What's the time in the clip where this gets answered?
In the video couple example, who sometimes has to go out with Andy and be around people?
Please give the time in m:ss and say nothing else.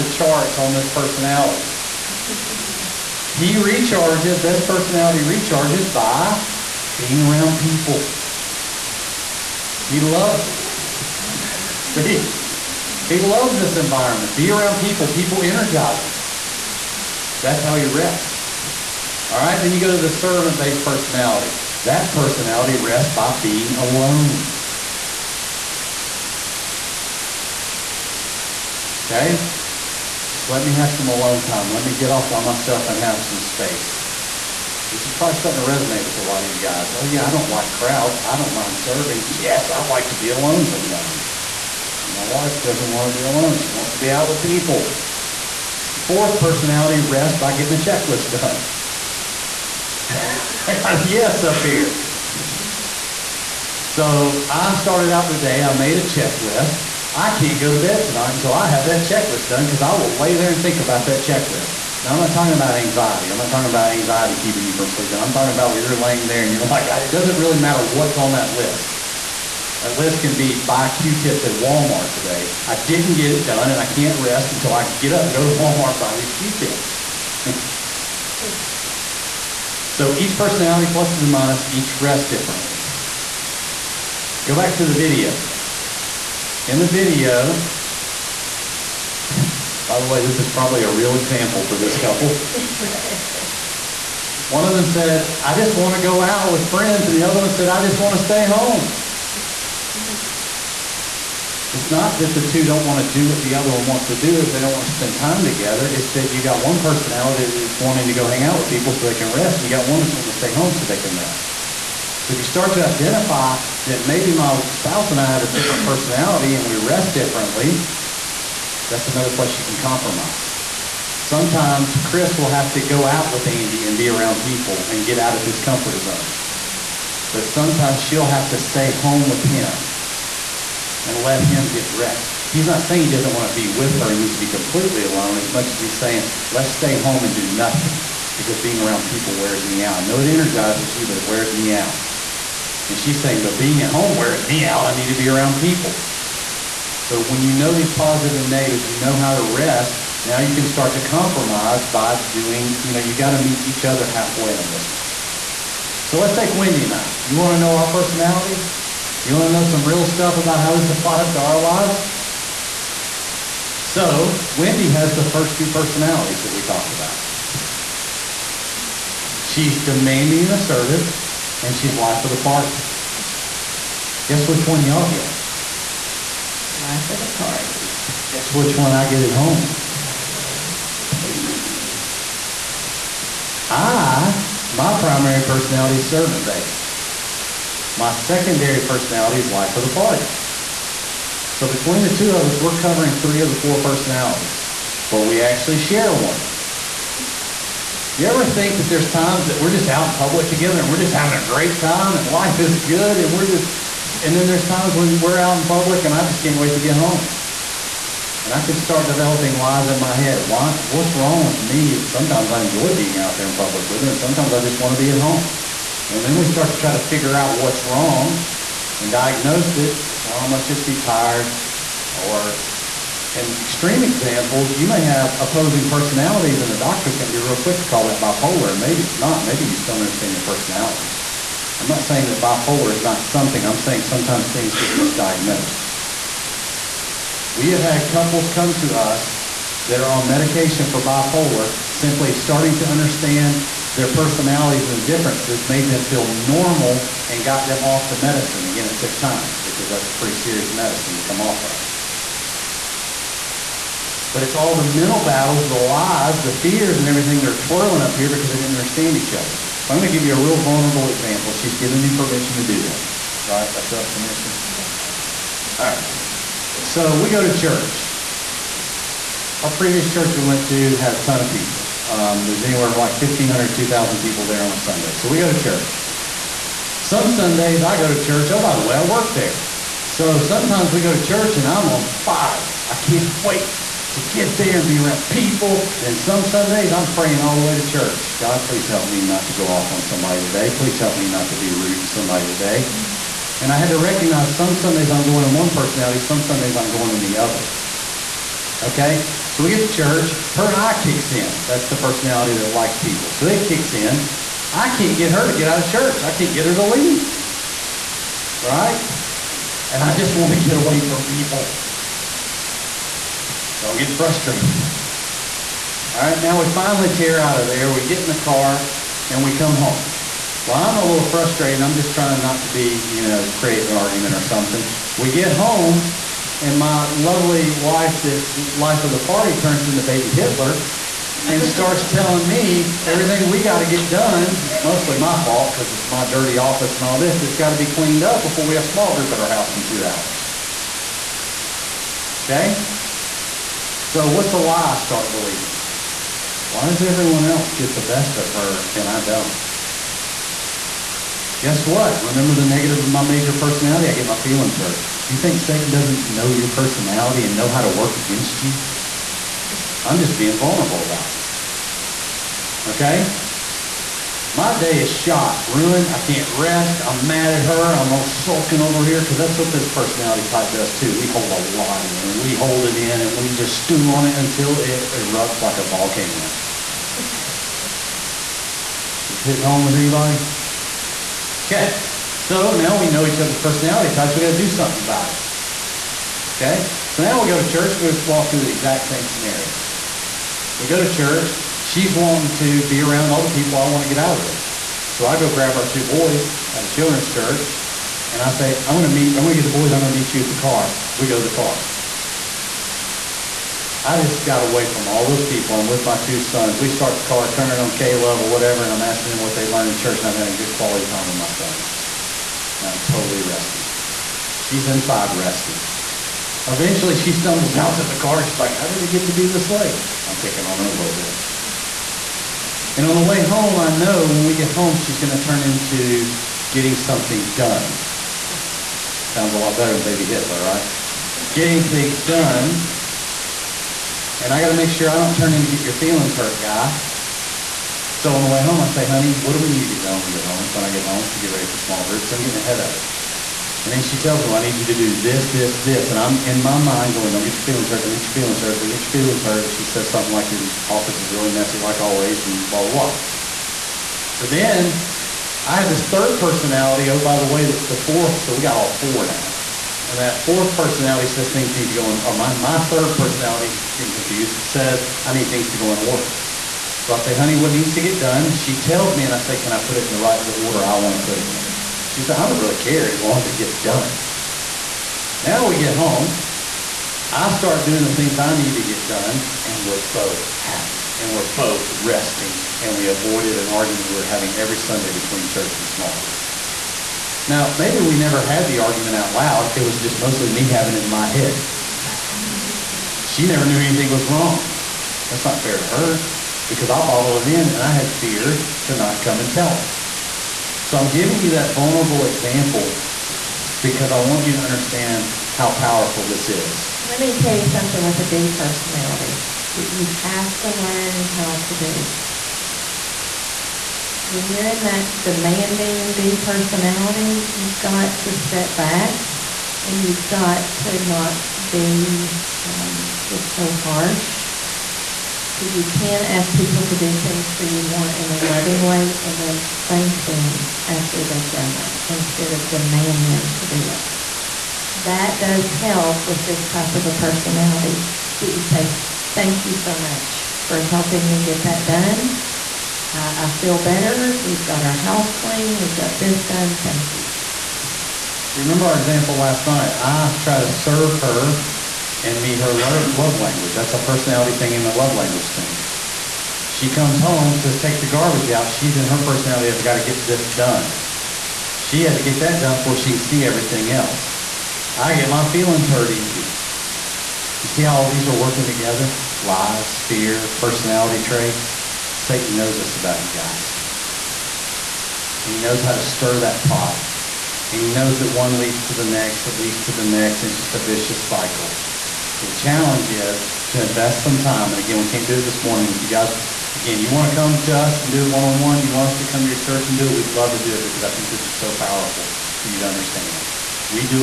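2:02.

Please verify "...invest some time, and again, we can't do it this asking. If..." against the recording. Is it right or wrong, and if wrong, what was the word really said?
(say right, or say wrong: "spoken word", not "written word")
wrong: "morning", not "asking".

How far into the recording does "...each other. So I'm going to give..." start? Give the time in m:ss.
4:19.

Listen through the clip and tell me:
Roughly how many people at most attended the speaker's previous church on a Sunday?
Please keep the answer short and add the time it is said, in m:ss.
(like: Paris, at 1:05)
2,000, at 4:33.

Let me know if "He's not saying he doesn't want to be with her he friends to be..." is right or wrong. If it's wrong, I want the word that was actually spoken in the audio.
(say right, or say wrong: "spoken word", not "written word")
wrong: "needs", not "friends".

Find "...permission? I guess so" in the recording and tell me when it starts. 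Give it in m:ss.
4:24.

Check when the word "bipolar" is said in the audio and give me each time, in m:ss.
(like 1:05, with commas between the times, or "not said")
3:48, 3:52, 4:00.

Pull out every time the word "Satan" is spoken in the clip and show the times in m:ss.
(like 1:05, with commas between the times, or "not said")
5:55, 9:32.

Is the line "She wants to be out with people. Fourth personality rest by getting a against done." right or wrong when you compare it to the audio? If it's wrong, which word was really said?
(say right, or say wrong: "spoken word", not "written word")
wrong: "checklist", not "against".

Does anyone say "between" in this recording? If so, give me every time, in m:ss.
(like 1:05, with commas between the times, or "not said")
3:11, 8:05.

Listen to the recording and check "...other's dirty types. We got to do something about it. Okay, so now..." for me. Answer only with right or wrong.
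wrong.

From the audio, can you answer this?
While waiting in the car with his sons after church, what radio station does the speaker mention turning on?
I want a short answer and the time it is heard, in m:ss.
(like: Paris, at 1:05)
K-Love, at 6:47.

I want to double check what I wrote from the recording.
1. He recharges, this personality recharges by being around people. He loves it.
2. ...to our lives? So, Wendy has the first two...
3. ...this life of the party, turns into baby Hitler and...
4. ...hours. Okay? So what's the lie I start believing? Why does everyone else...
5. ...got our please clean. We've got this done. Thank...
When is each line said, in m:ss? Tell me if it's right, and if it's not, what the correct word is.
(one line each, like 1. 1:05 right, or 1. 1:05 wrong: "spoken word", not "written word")
1. 0:03 right
2. 2:41 right
3. 5:28 right
4. 5:40 right
5. 9:04 wrong: "house", not "please".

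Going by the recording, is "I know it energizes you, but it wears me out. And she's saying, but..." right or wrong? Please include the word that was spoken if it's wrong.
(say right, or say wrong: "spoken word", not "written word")
right.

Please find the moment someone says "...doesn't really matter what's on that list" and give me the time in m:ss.
1:07.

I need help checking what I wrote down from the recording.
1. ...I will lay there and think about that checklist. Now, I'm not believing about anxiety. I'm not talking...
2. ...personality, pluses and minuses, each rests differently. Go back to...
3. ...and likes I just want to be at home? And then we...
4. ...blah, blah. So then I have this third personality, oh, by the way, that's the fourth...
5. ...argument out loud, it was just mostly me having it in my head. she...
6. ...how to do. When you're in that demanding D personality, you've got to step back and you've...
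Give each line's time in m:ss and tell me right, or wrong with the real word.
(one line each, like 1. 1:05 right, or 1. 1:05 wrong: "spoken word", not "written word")
1. 0:59 wrong: "talking", not "believing"
2. 1:20 right
3. 3:34 wrong: "sometimes", not "likes"
4. 7:32 right
5. 8:08 right
6. 8:31 right.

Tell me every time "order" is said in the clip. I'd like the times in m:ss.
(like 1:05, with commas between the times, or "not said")
7:45, 7:50.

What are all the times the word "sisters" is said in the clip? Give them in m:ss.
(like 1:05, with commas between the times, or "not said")
not said.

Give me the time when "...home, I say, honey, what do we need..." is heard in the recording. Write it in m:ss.
7:18.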